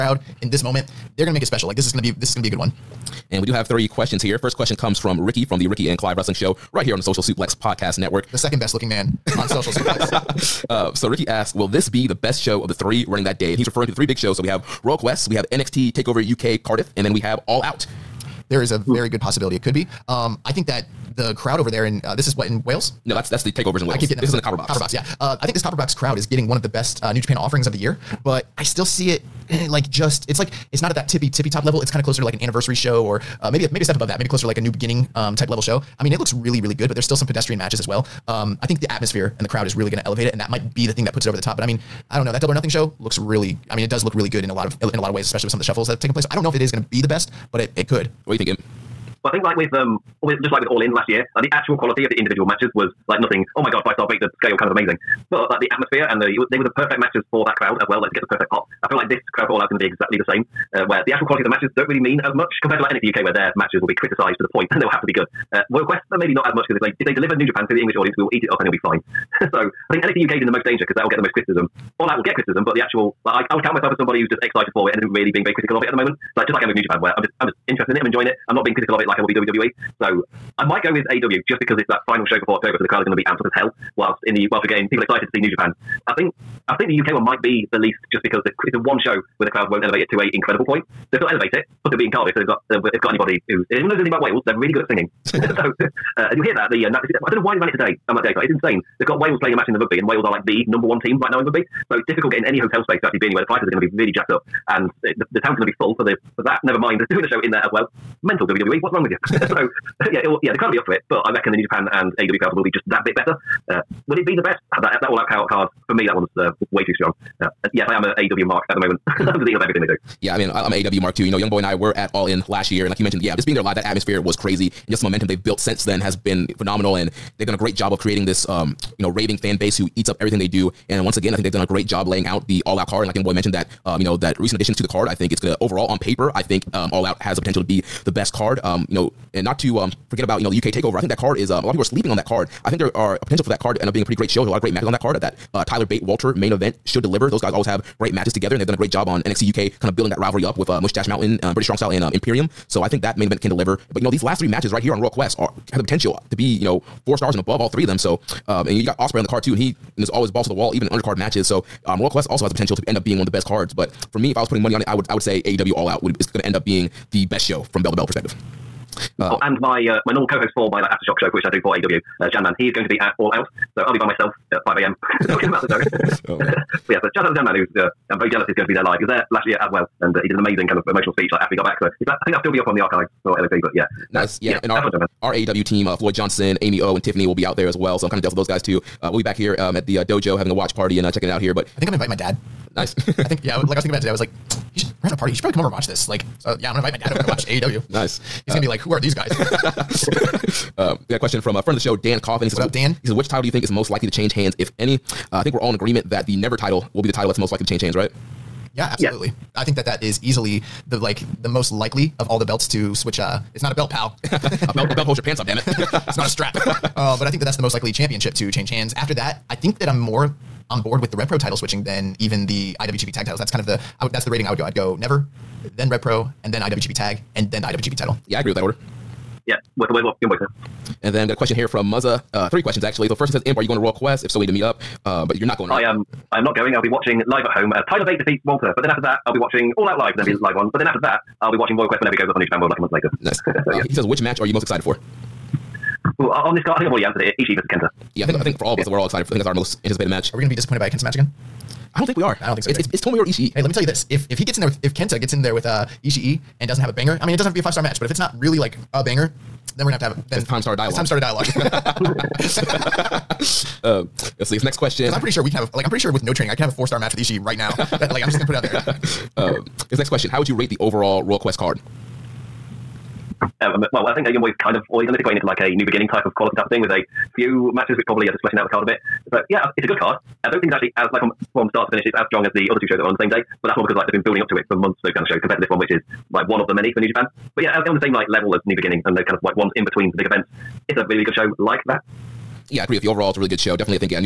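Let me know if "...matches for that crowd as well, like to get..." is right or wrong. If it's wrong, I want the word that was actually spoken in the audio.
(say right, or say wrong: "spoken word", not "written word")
right.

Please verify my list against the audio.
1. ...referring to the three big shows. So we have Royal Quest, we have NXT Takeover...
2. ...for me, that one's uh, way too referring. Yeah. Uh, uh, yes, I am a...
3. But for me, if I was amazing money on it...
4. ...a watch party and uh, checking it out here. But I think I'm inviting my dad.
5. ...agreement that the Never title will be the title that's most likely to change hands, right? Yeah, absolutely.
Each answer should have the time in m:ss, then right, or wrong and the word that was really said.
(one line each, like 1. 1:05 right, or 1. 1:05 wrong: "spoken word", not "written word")
1. 0:13 right
2. 1:55 wrong: "strong", not "referring"
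3. 2:43 wrong: "putting", not "amazing"
4. 3:10 right
5. 3:25 right.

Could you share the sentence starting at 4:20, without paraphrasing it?
Then it's time to start a dialogue.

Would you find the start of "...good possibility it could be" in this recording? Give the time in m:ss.
0:19.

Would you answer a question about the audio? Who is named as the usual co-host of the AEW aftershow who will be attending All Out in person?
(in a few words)
Janman.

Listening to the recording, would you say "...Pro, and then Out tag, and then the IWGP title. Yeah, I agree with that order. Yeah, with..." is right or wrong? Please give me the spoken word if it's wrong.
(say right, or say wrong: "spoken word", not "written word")
wrong: "IWGP", not "Out".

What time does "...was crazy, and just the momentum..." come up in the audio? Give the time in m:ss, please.
2:04.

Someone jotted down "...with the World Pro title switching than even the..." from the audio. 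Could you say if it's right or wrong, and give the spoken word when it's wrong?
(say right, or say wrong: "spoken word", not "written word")
wrong: "Rev", not "World".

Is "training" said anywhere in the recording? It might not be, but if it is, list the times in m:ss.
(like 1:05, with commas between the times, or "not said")
4:26.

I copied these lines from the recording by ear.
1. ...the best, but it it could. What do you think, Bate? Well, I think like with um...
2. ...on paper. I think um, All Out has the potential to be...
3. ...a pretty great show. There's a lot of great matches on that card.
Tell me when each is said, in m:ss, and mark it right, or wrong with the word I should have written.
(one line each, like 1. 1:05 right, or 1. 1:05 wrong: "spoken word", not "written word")
1. 0:47 wrong: "Imp", not "Bate"
2. 2:15 right
3. 2:24 right.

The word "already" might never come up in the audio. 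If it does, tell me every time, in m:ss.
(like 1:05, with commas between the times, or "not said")
4:06, 4:34.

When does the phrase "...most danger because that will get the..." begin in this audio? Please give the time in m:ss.
1:10.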